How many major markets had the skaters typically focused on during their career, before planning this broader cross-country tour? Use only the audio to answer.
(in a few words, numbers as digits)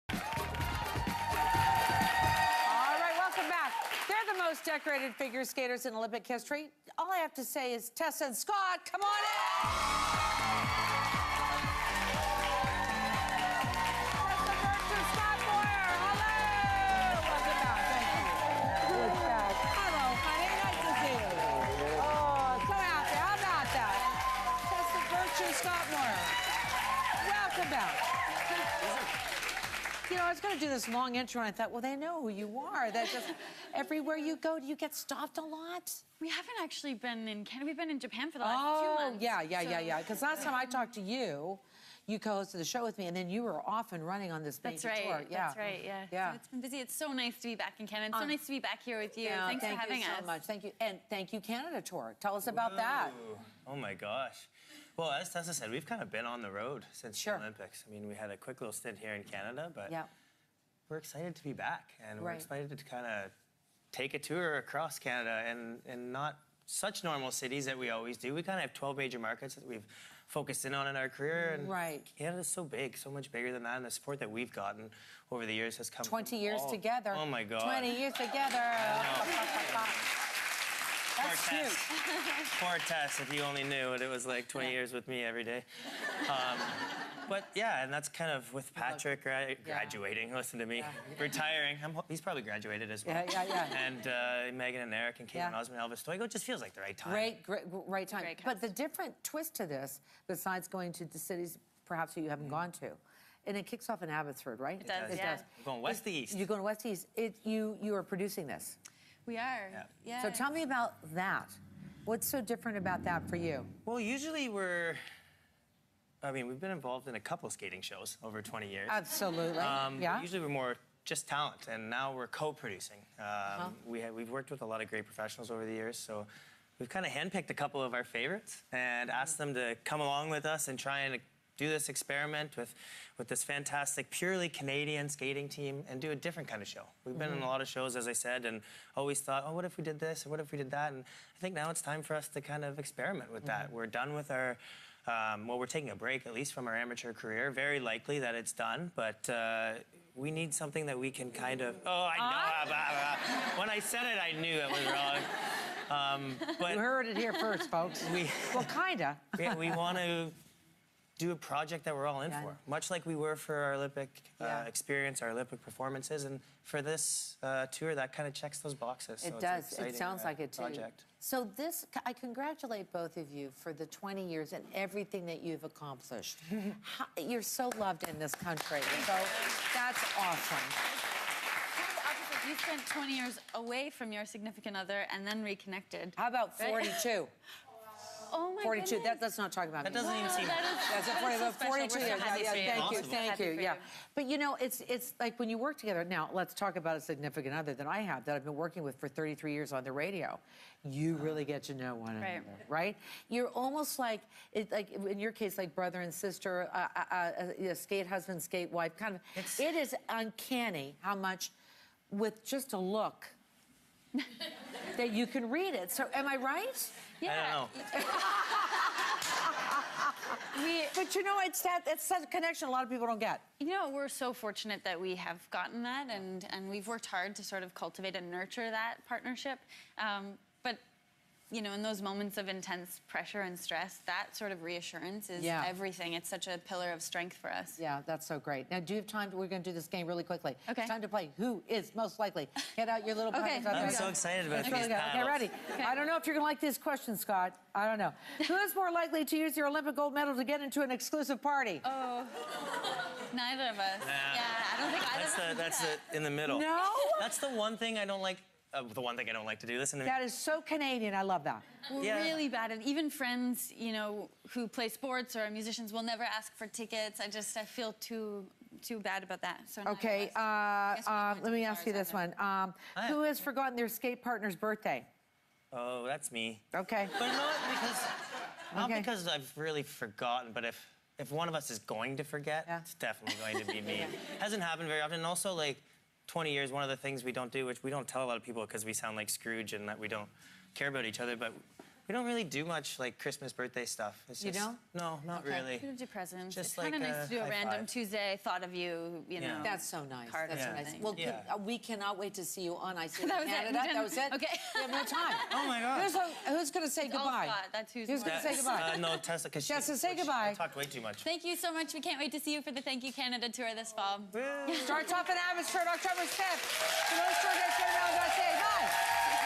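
12.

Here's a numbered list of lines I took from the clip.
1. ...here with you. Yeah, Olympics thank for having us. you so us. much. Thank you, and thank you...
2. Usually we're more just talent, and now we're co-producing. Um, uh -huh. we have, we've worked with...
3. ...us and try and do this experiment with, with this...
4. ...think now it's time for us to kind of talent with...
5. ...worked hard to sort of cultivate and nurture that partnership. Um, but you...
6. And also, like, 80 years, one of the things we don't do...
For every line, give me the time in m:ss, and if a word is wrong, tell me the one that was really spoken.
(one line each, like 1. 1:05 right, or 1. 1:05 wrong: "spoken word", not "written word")
1. 0:48 wrong: "Thanks", not "Olympics"
2. 2:00 right
3. 2:10 right
4. 2:21 wrong: "experiment", not "talent"
5. 3:46 right
6. 4:45 wrong: "20", not "80".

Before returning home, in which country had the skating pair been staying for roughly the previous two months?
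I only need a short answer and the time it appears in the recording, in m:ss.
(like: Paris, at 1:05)
Japan, at 0:37.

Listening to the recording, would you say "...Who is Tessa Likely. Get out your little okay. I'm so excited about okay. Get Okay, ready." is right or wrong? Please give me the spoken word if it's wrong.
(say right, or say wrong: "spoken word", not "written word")
wrong: "Most", not "Tessa".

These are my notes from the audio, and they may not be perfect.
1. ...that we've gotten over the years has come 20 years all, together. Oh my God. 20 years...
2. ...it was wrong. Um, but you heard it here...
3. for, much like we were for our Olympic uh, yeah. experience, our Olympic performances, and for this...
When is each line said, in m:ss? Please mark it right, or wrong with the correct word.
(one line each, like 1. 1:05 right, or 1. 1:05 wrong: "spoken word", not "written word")
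1. 1:14 right
2. 2:34 right
3. 2:42 right.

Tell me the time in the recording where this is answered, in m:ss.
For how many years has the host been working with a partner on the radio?
3:19.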